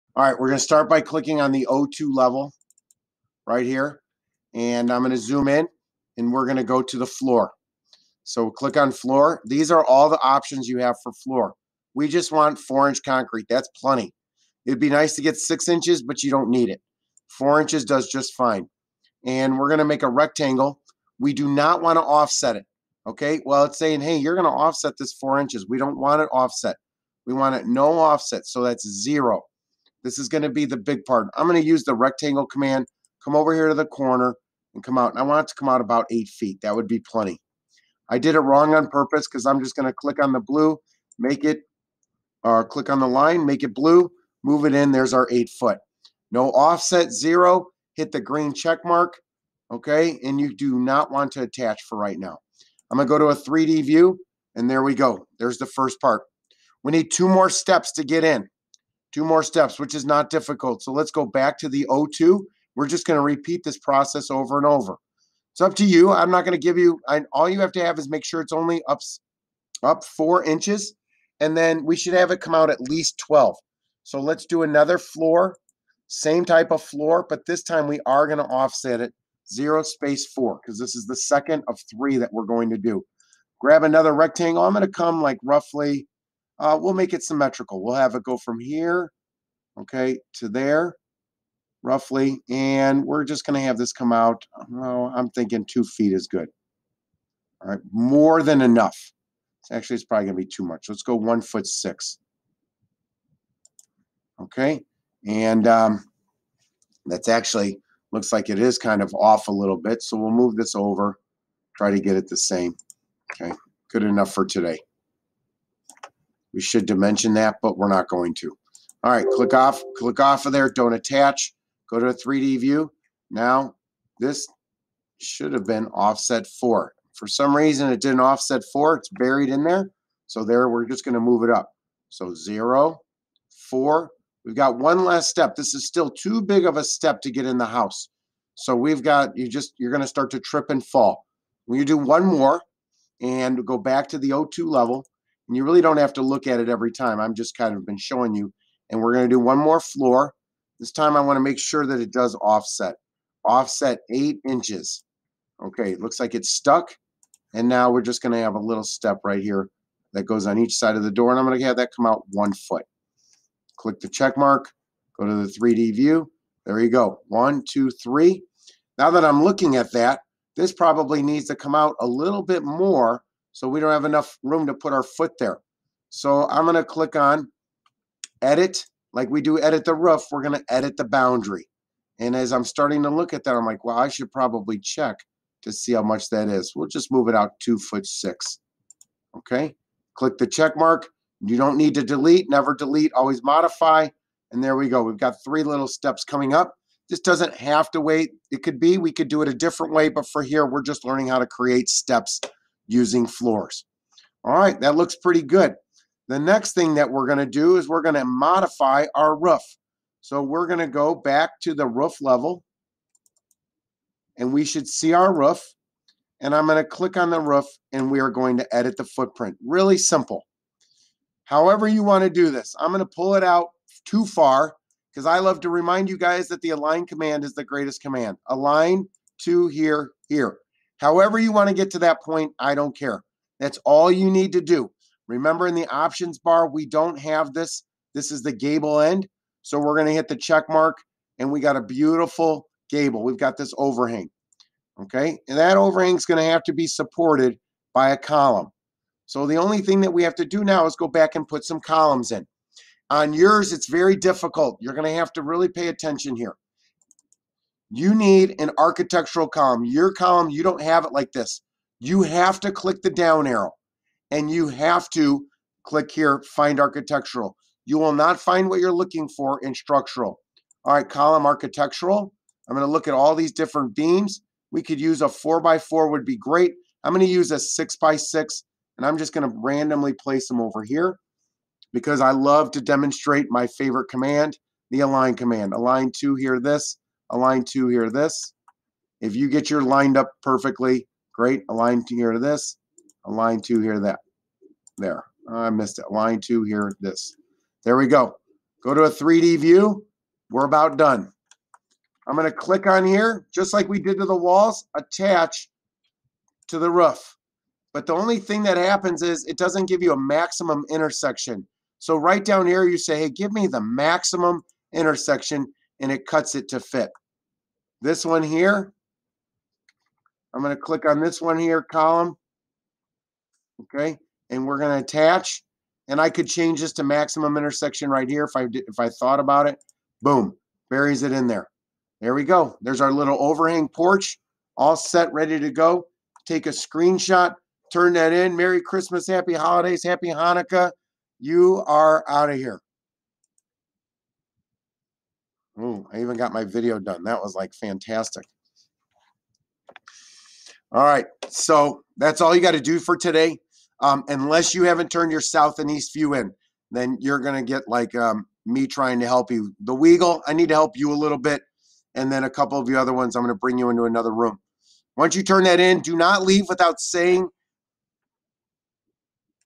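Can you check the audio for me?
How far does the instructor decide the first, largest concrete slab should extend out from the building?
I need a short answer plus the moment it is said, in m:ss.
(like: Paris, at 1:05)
8 feet, at 0:35.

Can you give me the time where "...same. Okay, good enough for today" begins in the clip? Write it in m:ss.
1:52.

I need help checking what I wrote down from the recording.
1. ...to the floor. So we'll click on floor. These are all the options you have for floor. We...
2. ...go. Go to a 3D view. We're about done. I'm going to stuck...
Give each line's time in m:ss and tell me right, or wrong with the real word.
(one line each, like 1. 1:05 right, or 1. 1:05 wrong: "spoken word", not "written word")
1. 0:06 right
2. 4:58 wrong: "click", not "stuck".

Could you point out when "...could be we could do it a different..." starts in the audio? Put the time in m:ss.
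3:18.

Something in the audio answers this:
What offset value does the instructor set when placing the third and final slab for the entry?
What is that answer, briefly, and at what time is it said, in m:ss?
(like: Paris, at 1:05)
8 inches, at 2:33.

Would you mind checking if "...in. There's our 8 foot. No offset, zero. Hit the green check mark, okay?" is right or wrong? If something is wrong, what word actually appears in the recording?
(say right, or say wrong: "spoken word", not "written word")
right.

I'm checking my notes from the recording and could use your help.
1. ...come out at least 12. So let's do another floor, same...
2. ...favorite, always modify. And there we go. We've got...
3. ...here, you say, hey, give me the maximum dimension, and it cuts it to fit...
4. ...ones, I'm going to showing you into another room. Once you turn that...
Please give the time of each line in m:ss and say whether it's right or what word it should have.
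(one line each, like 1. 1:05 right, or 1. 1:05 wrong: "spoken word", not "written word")
1. 1:12 right
2. 3:12 wrong: "delete", not "favorite"
3. 5:12 wrong: "intersection", not "dimension"
4. 6:03 wrong: "bring", not "showing".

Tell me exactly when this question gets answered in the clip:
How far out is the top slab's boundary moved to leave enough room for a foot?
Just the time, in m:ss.
3:07.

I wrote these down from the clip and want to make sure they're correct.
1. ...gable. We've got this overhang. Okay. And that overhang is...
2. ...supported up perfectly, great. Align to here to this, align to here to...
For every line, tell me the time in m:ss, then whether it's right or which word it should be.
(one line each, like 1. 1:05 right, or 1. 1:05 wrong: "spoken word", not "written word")
1. 4:02 right
2. 4:49 wrong: "lined", not "supported".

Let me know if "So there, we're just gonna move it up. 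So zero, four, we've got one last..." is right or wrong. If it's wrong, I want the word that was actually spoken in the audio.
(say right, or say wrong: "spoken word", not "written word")
right.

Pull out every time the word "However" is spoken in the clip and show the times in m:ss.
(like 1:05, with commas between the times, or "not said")
3:41, 3:51.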